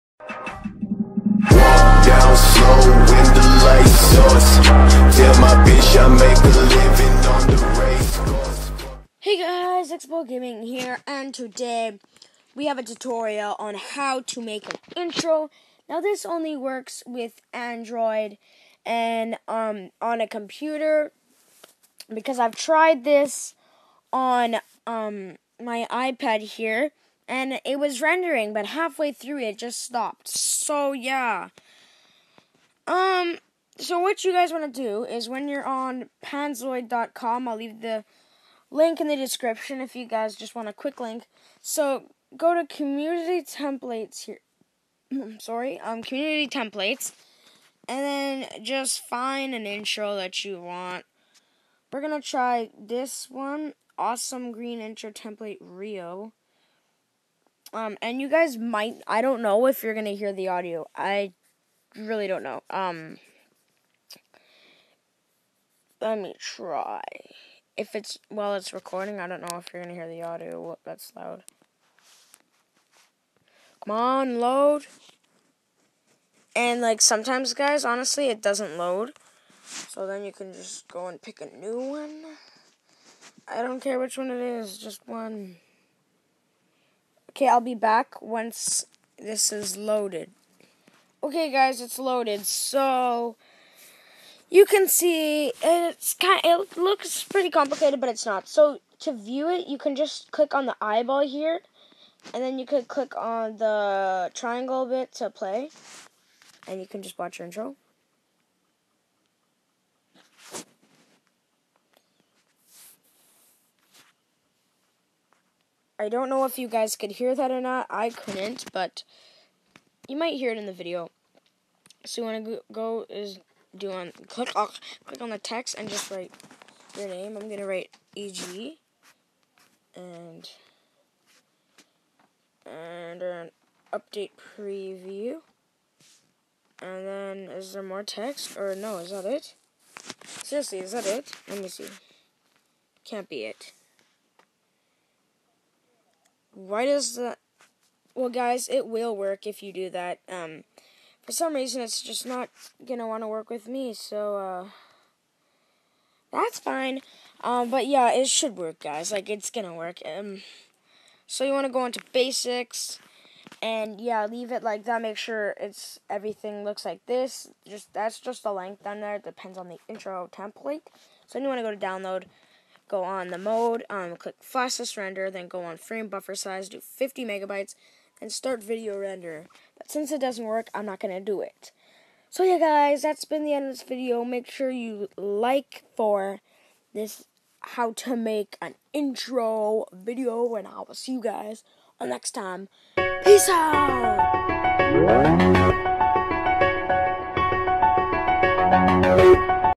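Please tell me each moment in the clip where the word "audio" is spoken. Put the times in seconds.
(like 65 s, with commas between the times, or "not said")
60 s, 70 s.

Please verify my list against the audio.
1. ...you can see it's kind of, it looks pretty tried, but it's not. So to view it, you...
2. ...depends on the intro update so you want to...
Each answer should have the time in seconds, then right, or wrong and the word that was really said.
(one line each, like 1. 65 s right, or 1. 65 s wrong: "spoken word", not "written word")
1. 94 s wrong: "complicated", not "tried"
2. 169 s wrong: "template", not "update".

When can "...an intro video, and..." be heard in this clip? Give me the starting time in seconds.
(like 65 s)
188 s.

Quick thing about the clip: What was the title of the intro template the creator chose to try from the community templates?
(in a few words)
awesome green intro template Rio.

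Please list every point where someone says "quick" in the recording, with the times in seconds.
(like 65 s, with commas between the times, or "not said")
40 s.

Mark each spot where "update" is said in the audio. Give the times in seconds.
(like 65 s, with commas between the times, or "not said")
133 s.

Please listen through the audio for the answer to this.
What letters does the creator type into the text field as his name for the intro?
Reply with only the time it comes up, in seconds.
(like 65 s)
128 s.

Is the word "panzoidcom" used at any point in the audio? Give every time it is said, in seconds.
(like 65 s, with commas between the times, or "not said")
36 s.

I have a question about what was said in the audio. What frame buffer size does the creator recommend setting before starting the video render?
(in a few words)
50 megabytes.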